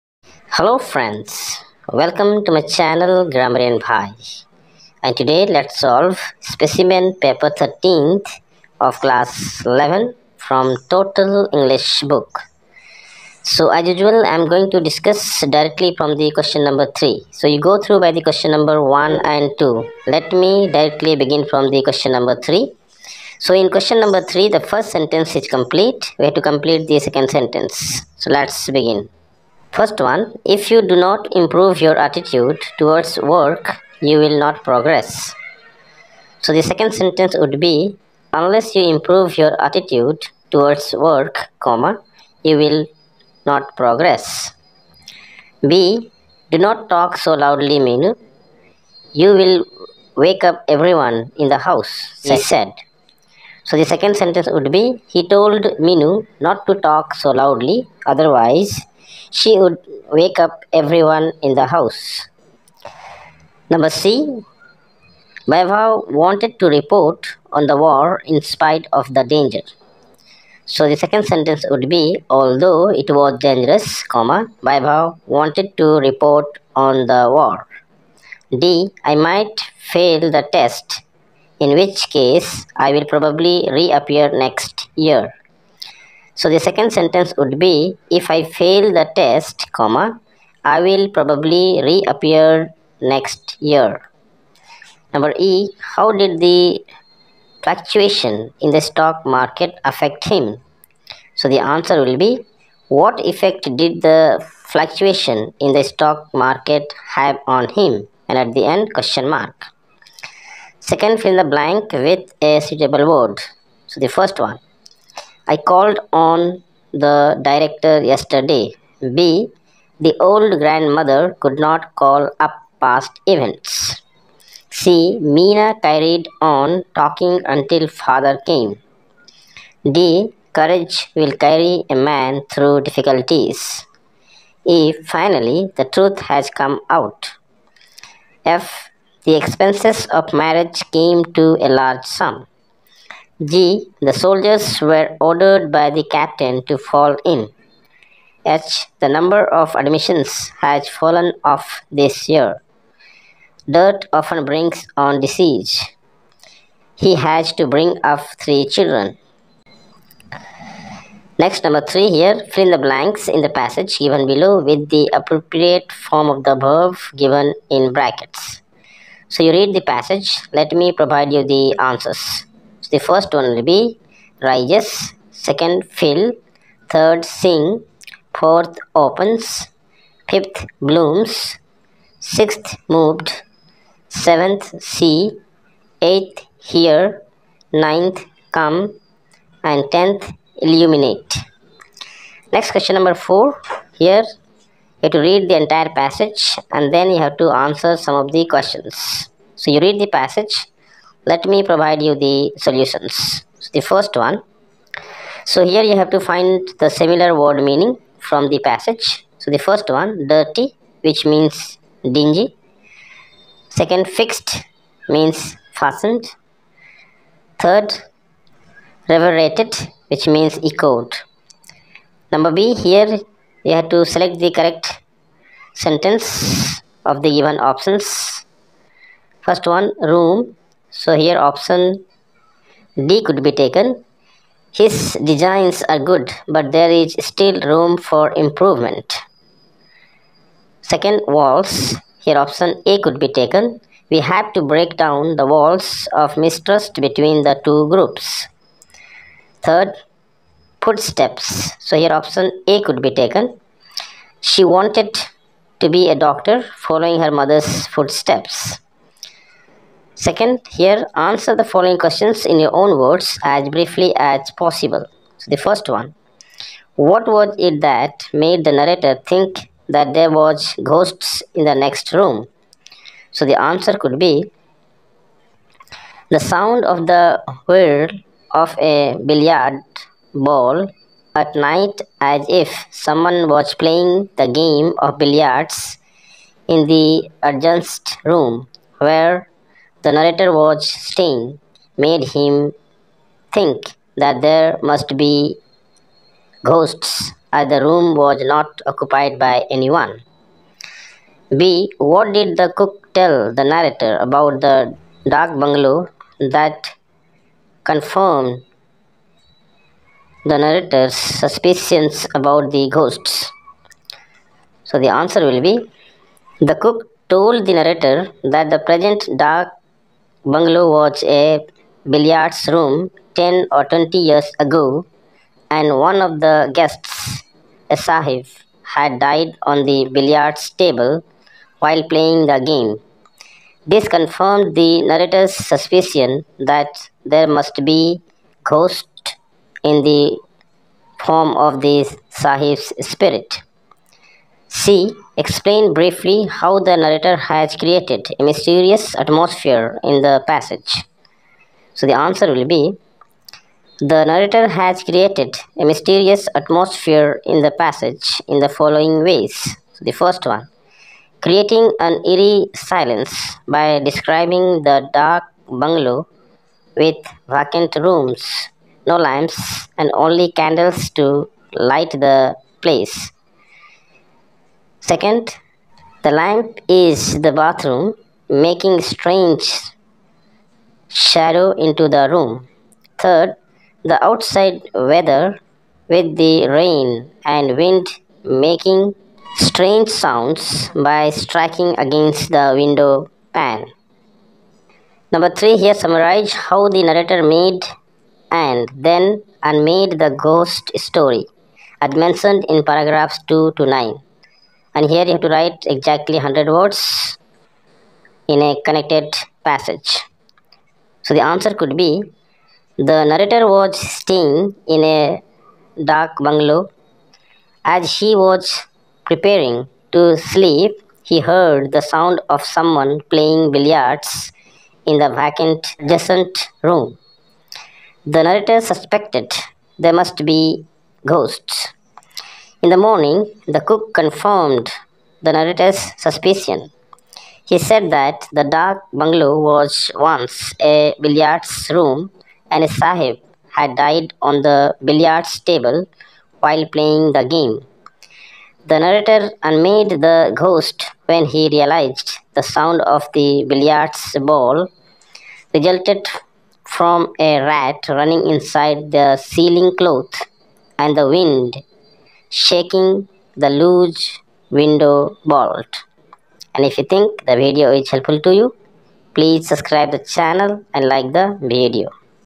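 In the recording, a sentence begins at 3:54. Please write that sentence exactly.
His designs are good, but there is still room for improvement.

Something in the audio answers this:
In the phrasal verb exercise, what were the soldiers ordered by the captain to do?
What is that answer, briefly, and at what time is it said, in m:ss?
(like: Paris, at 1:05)
fall in, at 2:26.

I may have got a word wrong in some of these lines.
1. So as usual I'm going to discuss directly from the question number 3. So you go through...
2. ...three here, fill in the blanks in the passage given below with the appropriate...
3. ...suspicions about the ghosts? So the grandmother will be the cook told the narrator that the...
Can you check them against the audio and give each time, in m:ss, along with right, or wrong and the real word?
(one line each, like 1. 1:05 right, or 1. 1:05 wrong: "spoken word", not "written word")
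1. 0:13 right
2. 2:41 right
3. 5:11 wrong: "answer", not "grandmother".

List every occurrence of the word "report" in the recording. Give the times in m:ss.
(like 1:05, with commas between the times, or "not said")
1:06, 1:15.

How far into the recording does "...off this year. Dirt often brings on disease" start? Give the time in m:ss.
2:31.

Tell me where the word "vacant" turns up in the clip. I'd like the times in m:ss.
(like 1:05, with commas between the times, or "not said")
6:07, 7:05.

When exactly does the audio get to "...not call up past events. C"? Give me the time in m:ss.
2:01.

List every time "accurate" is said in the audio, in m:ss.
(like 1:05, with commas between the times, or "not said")
not said.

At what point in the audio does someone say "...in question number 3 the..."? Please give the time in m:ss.
0:23.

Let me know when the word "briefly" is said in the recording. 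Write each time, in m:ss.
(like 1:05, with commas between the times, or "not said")
4:23, 5:45.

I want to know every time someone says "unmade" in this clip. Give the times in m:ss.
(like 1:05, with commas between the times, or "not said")
6:39, 7:29.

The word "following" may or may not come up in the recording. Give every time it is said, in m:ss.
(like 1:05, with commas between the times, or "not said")
4:16, 4:21, 5:58.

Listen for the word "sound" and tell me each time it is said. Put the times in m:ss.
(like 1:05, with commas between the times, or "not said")
4:36, 6:30, 7:02, 7:32.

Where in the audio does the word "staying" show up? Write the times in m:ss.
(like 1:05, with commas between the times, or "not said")
4:51, 6:53.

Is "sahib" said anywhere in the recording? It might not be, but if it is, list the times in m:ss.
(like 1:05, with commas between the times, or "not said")
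5:27, 5:42, 7:22.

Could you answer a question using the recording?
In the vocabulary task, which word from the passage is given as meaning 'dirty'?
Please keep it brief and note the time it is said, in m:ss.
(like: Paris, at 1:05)
dingy, at 3:32.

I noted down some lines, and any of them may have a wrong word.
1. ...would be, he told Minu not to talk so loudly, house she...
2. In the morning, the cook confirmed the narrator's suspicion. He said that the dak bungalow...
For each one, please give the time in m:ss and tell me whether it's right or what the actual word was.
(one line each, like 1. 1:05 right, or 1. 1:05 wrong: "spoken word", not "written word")
1. 0:54 wrong: "otherwise", not "house"
2. 7:12 right.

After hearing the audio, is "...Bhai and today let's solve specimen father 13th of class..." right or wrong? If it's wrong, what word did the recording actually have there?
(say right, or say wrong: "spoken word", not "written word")
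wrong: "paper", not "father".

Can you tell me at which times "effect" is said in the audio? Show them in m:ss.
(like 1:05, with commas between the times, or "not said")
1:43.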